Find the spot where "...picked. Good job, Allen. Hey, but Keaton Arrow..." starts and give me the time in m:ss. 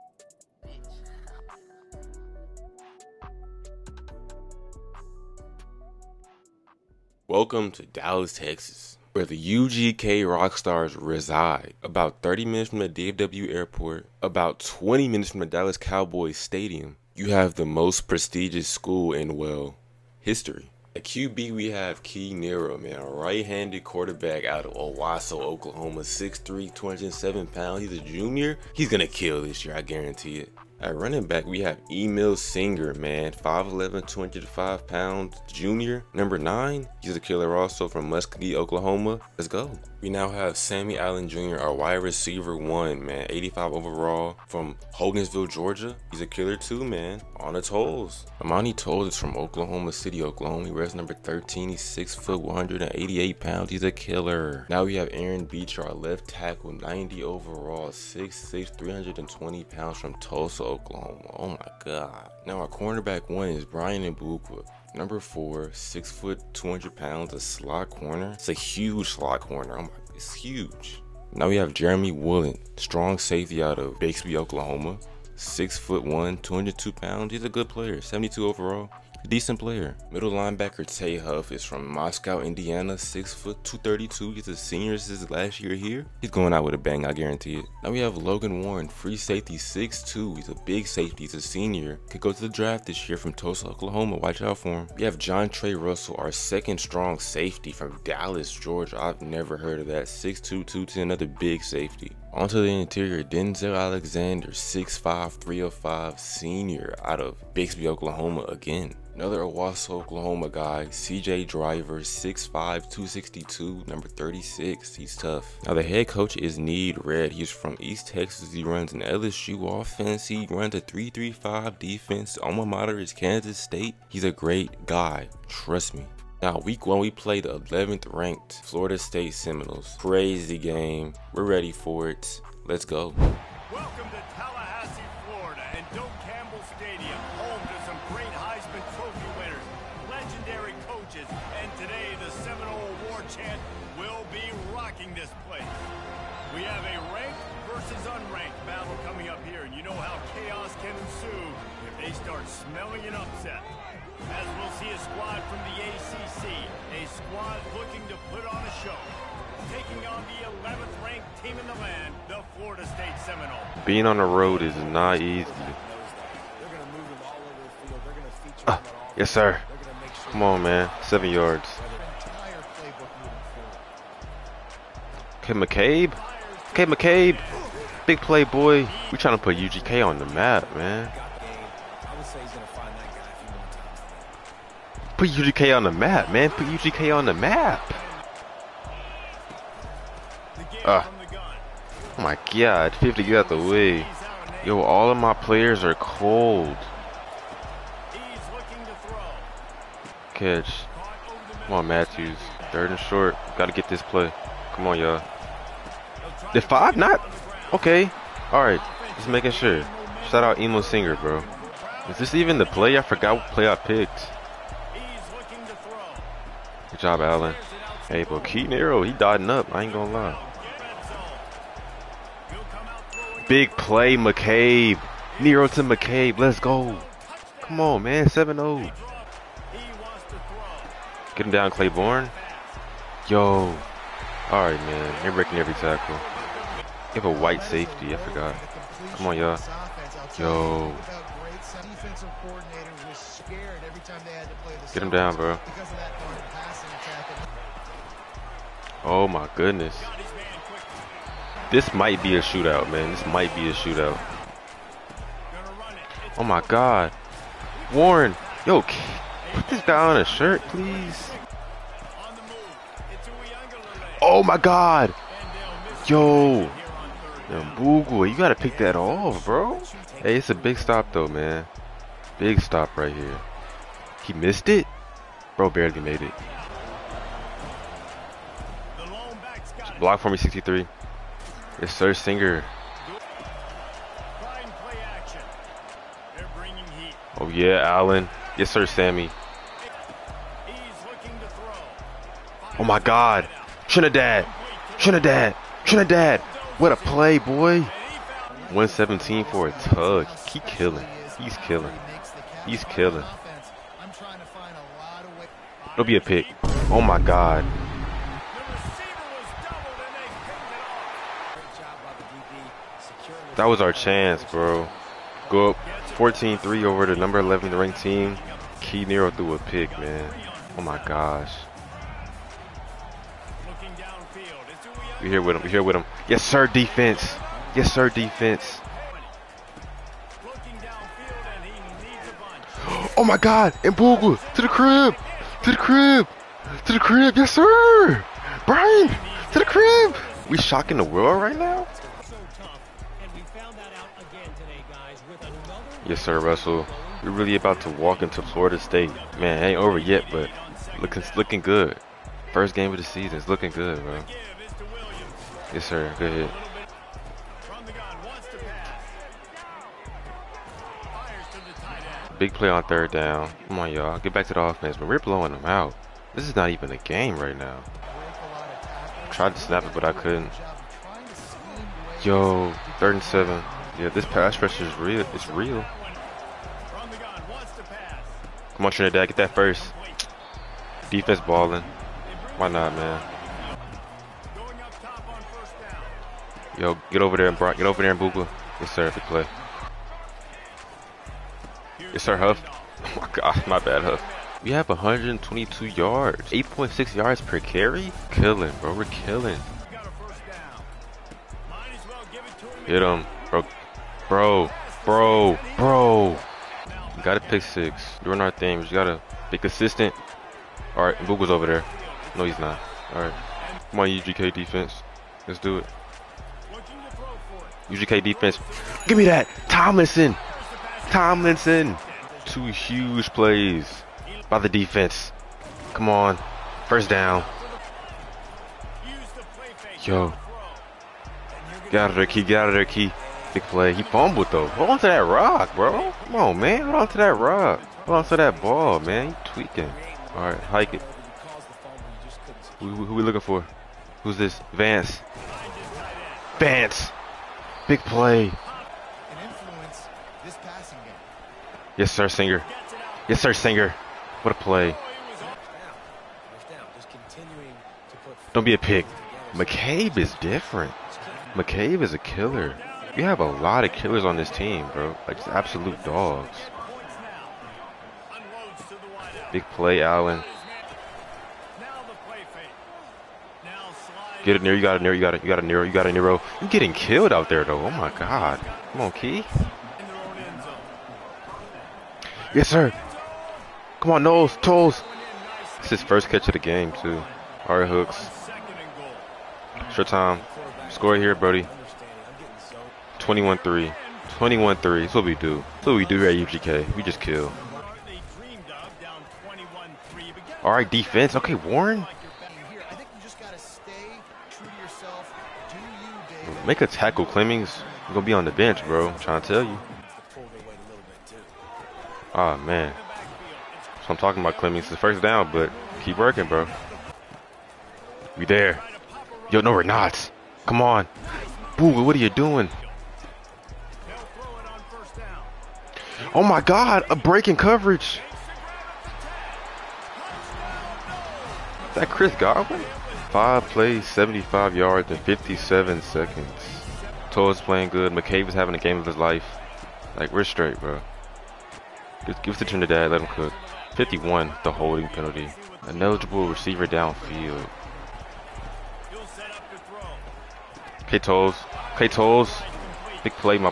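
3:33.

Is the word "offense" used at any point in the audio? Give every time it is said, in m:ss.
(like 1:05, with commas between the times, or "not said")
1:59, 6:04.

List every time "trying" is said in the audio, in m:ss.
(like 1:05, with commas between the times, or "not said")
2:59, 8:29.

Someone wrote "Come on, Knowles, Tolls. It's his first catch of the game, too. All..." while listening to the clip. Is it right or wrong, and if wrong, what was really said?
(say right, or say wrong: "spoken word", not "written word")
right.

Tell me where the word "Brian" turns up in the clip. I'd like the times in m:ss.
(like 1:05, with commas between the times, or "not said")
1:03, 5:38.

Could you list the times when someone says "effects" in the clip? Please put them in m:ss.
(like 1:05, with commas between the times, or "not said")
not said.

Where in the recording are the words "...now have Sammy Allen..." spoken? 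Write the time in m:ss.
0:40.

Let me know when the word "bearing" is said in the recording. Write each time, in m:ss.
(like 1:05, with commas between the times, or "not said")
not said.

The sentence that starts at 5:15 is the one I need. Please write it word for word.
Go up 14-3 over the number 11 ranked team.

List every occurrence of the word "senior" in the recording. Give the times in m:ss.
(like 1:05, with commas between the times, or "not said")
1:24, 1:31, 1:46.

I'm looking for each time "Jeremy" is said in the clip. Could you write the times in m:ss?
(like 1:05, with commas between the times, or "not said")
1:11.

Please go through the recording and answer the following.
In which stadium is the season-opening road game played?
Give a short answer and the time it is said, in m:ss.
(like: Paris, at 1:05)
Doak Campbell Stadium, at 2:15.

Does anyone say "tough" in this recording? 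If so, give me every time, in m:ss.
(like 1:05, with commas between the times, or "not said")
1:55.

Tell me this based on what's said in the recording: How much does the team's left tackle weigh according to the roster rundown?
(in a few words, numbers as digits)
320 pounds.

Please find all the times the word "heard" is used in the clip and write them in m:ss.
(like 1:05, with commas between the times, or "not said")
1:39.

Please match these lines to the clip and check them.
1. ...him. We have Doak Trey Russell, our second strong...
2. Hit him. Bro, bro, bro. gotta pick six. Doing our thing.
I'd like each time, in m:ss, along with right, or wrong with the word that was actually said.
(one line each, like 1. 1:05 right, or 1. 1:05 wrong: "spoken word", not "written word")
1. 1:34 wrong: "John", not "Doak"
2. 6:42 right.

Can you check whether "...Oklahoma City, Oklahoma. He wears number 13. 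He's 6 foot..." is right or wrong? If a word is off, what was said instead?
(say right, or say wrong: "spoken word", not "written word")
right.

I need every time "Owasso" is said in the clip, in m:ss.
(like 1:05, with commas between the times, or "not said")
0:24, 1:49.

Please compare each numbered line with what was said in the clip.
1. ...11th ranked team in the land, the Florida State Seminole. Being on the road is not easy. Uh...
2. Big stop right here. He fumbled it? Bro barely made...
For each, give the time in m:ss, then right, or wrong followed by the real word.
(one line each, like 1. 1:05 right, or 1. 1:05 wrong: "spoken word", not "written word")
1. 2:40 right
2. 4:32 wrong: "missed", not "fumbled".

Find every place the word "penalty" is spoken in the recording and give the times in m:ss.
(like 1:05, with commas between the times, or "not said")
9:05.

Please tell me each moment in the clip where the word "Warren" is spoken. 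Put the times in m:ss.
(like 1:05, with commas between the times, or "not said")
1:28, 4:17, 8:21.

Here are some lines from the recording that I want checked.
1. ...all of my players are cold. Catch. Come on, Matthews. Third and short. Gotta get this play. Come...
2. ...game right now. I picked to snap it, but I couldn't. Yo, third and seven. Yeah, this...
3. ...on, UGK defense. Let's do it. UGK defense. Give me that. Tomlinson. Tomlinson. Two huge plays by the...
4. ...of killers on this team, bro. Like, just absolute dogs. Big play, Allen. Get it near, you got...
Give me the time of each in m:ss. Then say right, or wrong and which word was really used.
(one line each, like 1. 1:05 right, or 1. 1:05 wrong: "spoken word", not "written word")
1. 3:14 right
2. 6:06 wrong: "tried", not "picked"
3. 6:54 right
4. 7:43 right.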